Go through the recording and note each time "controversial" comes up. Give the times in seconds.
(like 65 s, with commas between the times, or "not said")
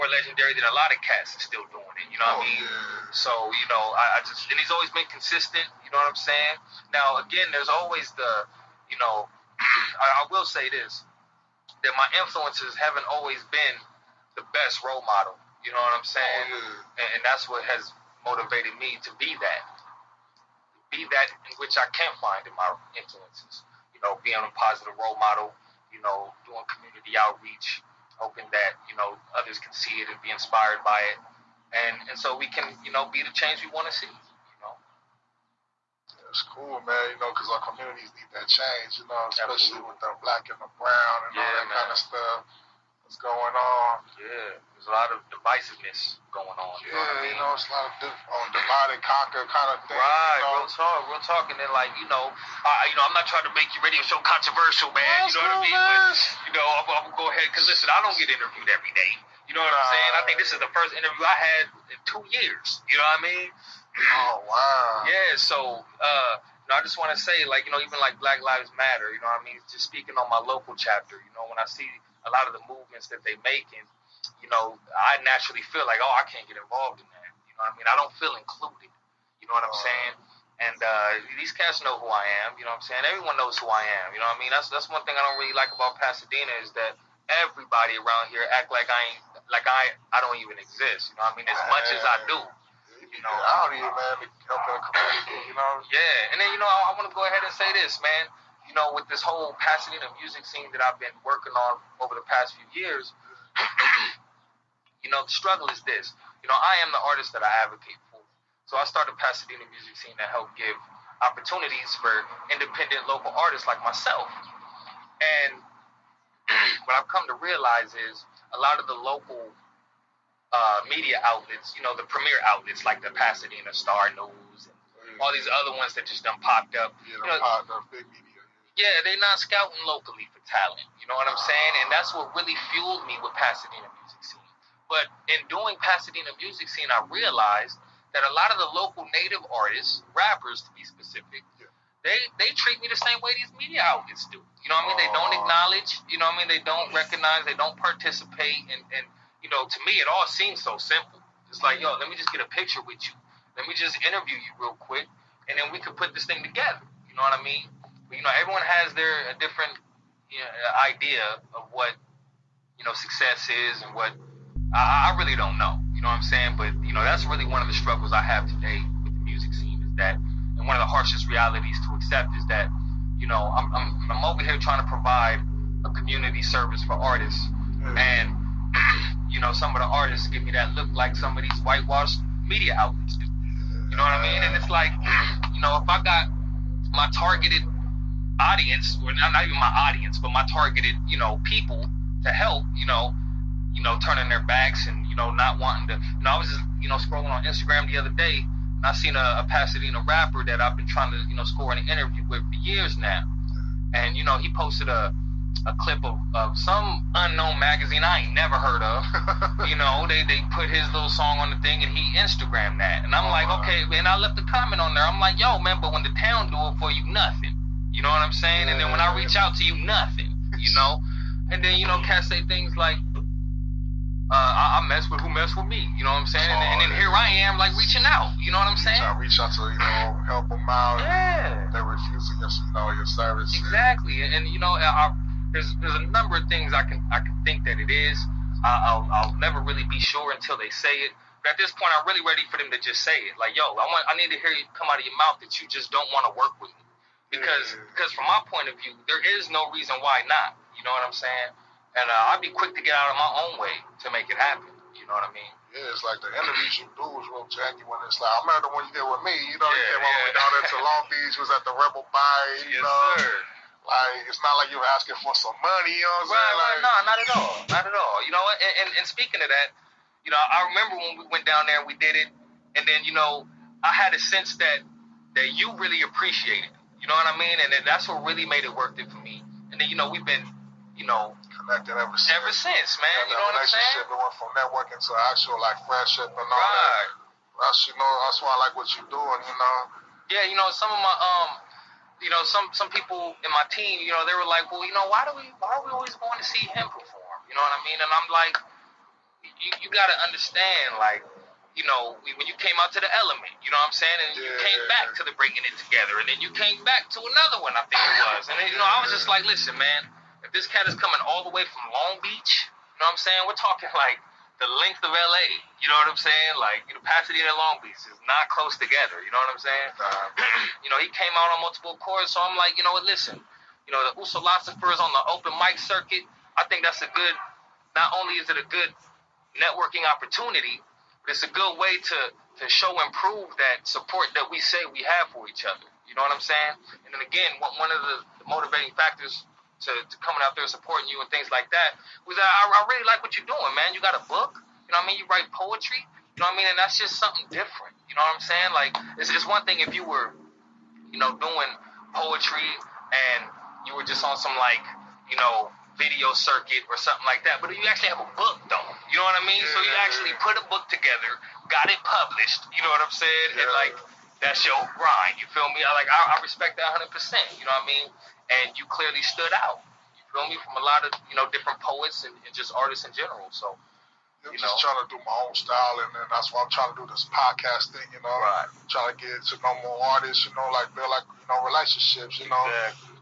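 54 s.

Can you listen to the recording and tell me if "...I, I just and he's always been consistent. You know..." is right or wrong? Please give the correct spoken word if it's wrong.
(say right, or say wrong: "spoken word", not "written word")
right.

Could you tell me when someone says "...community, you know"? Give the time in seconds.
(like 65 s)
94 s.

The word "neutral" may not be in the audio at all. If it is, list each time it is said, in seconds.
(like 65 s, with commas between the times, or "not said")
not said.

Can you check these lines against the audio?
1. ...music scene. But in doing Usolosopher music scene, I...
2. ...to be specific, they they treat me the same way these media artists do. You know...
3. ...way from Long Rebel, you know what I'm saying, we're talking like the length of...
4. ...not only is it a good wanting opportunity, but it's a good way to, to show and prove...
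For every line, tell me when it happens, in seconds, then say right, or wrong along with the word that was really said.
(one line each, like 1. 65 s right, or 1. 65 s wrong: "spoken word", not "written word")
1. 133 s wrong: "Pasadena", not "Usolosopher"
2. 140 s wrong: "outlets", not "artists"
3. 311 s wrong: "Beach", not "Rebel"
4. 327 s wrong: "networking", not "wanting".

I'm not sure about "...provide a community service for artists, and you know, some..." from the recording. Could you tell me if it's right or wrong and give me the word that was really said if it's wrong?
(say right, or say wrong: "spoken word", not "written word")
right.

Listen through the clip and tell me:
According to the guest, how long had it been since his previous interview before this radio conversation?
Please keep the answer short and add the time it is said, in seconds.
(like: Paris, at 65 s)
2 years, at 62 s.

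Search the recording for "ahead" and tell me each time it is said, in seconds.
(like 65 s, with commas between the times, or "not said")
57 s, 97 s.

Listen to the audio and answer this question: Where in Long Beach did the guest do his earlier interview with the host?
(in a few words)
Rebel Buy.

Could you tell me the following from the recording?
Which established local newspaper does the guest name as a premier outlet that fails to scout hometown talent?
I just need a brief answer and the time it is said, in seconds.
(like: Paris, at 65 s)
Pasadena Star News, at 123 s.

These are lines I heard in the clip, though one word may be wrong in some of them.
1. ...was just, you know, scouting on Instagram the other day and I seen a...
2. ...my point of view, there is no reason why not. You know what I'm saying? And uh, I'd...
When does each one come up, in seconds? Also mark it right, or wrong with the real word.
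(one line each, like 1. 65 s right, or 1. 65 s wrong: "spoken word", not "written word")
1. 196 s wrong: "scrolling", not "scouting"
2. 248 s right.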